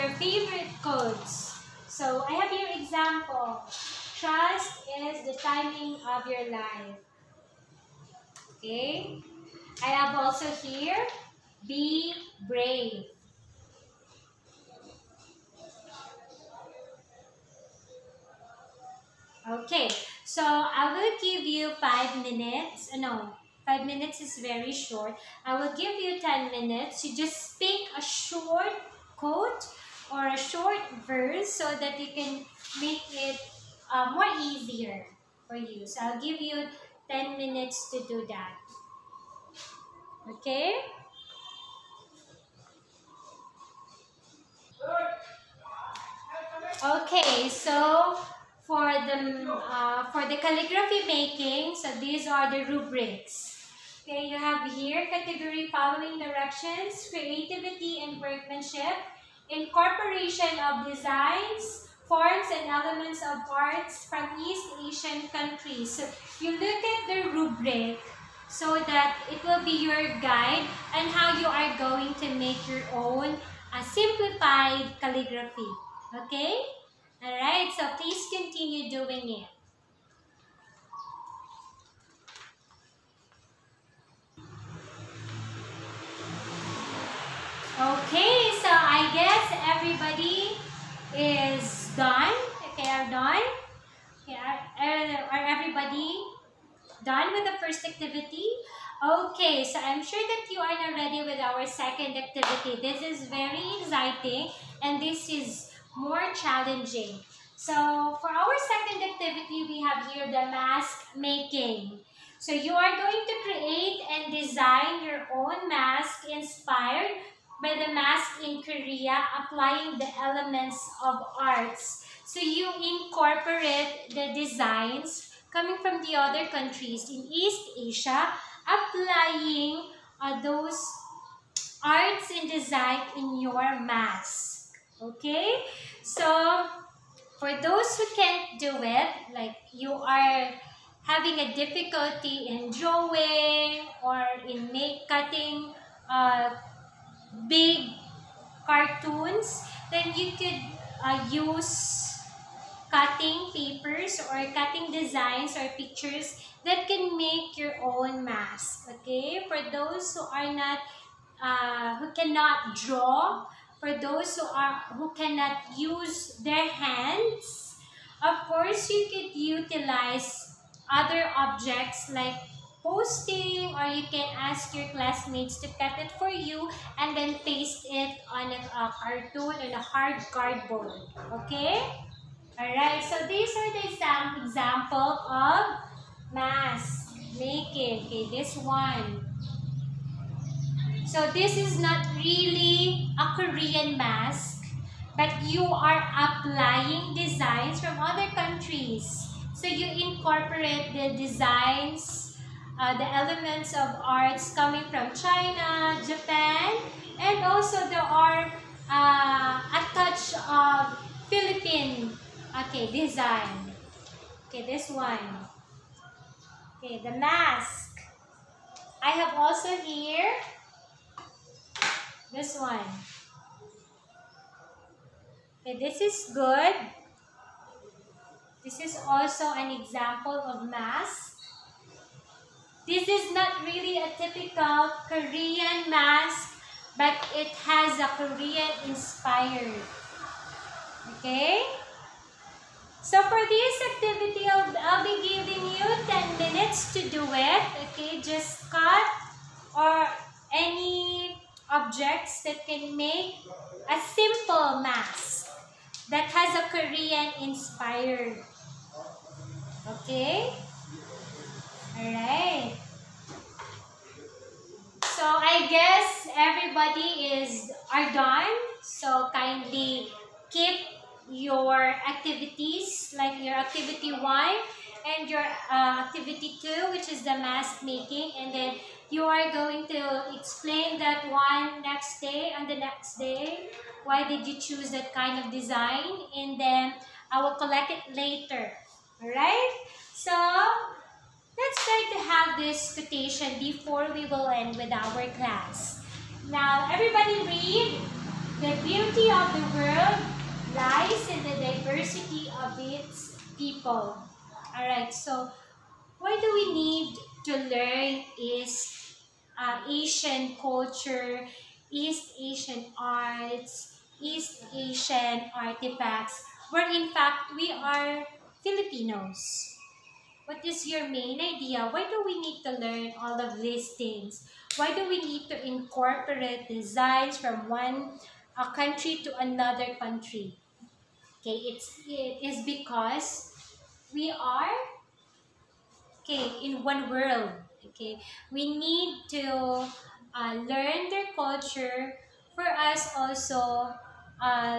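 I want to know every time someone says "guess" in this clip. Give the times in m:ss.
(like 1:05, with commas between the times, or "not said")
1:29, 4:25.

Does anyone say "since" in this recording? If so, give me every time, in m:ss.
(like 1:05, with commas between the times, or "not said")
not said.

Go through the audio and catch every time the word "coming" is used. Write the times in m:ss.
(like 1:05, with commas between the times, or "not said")
2:05, 3:24.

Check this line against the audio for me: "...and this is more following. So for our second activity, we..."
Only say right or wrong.
wrong.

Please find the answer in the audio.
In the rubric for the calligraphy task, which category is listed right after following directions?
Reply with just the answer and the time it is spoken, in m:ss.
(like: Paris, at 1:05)
Creativity and workmanship, at 0:57.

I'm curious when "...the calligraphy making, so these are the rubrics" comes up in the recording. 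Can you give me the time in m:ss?
0:50.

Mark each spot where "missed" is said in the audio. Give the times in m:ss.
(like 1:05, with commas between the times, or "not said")
not said.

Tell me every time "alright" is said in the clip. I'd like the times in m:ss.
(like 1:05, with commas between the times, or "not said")
1:17, 3:02, 4:21, 4:49, 5:04.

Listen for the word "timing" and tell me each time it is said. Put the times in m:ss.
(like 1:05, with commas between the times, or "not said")
0:05.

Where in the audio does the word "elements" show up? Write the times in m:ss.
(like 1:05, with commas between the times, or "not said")
1:02, 2:00, 3:23.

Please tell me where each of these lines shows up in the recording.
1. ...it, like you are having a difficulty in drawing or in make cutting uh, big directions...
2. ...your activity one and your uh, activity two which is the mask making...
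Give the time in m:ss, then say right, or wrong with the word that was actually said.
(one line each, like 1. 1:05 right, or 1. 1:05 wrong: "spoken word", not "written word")
1. 2:18 wrong: "cartoons", not "directions"
2. 4:33 right.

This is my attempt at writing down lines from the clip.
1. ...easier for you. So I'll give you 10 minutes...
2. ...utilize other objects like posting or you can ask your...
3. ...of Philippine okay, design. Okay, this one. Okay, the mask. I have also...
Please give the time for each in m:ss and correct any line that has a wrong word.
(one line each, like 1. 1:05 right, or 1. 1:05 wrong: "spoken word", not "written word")
1. 0:34 right
2. 2:49 right
3. 3:30 right.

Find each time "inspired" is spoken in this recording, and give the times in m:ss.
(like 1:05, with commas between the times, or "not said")
1:56, 3:58, 4:17.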